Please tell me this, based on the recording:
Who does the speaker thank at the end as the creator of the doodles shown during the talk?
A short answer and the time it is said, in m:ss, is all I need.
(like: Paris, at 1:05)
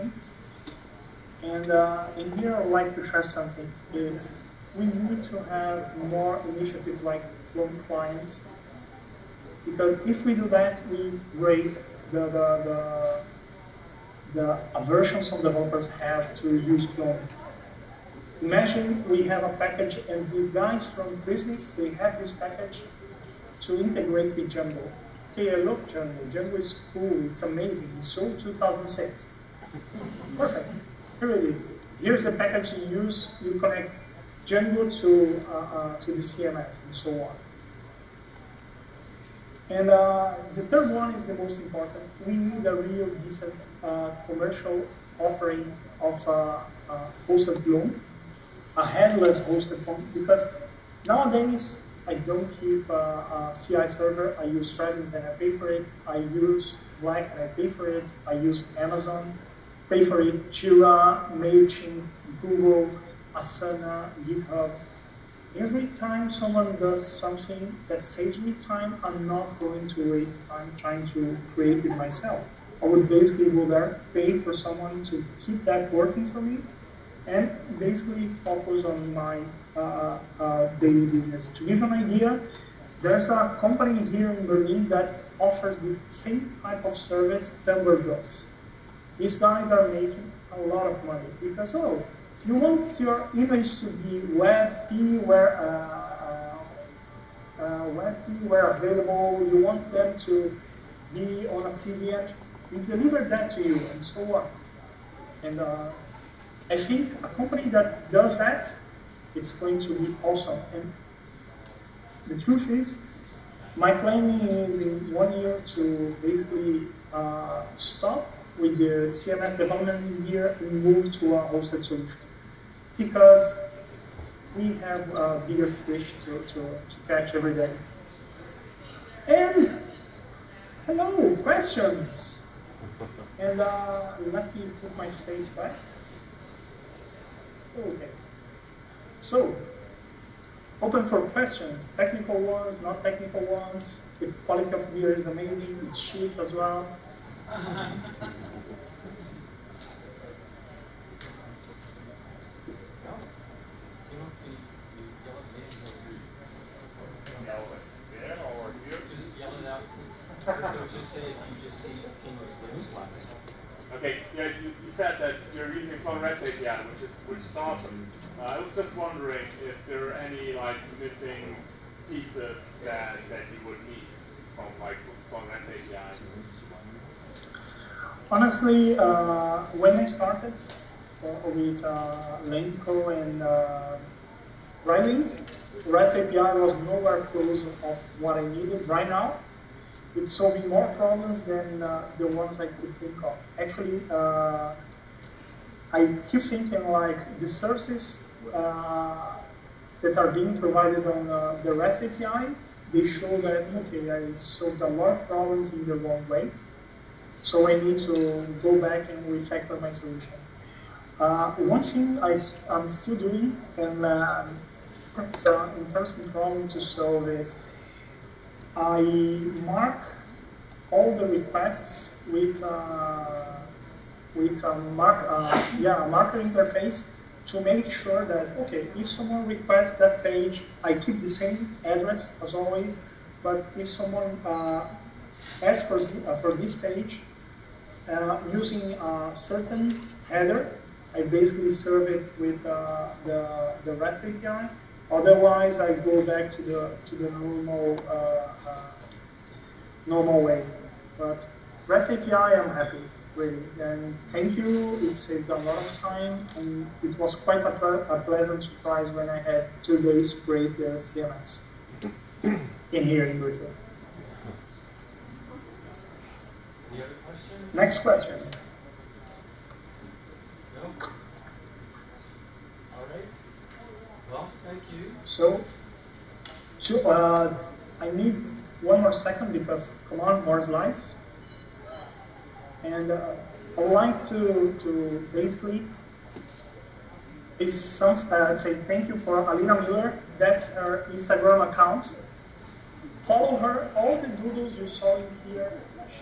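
Alina Miller, at 4:49.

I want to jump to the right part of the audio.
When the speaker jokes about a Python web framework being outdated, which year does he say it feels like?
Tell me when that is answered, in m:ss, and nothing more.
0:28.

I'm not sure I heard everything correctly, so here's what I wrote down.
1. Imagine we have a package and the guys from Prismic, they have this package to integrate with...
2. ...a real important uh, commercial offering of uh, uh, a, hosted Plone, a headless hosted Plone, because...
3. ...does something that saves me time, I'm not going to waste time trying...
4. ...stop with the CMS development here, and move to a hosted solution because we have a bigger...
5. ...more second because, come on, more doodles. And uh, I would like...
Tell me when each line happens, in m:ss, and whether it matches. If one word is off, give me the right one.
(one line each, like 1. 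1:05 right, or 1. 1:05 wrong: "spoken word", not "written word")
1. 0:18 right
2. 0:42 wrong: "decent", not "important"
3. 1:06 right
4. 1:57 right
5. 4:39 wrong: "slides", not "doodles".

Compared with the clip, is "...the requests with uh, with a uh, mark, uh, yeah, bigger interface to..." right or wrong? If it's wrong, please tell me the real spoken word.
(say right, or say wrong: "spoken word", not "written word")
wrong: "marker", not "bigger".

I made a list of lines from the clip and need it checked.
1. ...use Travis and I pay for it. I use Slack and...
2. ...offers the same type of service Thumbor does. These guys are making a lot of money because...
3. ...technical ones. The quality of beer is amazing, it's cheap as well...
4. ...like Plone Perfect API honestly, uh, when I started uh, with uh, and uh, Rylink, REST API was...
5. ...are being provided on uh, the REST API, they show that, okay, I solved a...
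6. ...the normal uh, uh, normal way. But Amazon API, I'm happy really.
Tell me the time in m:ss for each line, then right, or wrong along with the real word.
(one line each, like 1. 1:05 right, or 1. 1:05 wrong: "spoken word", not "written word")
1. 0:54 right
2. 1:25 right
3. 2:23 right
4. 2:54 wrong: "REST", not "Perfect"
5. 3:20 right
6. 4:07 wrong: "REST", not "Amazon".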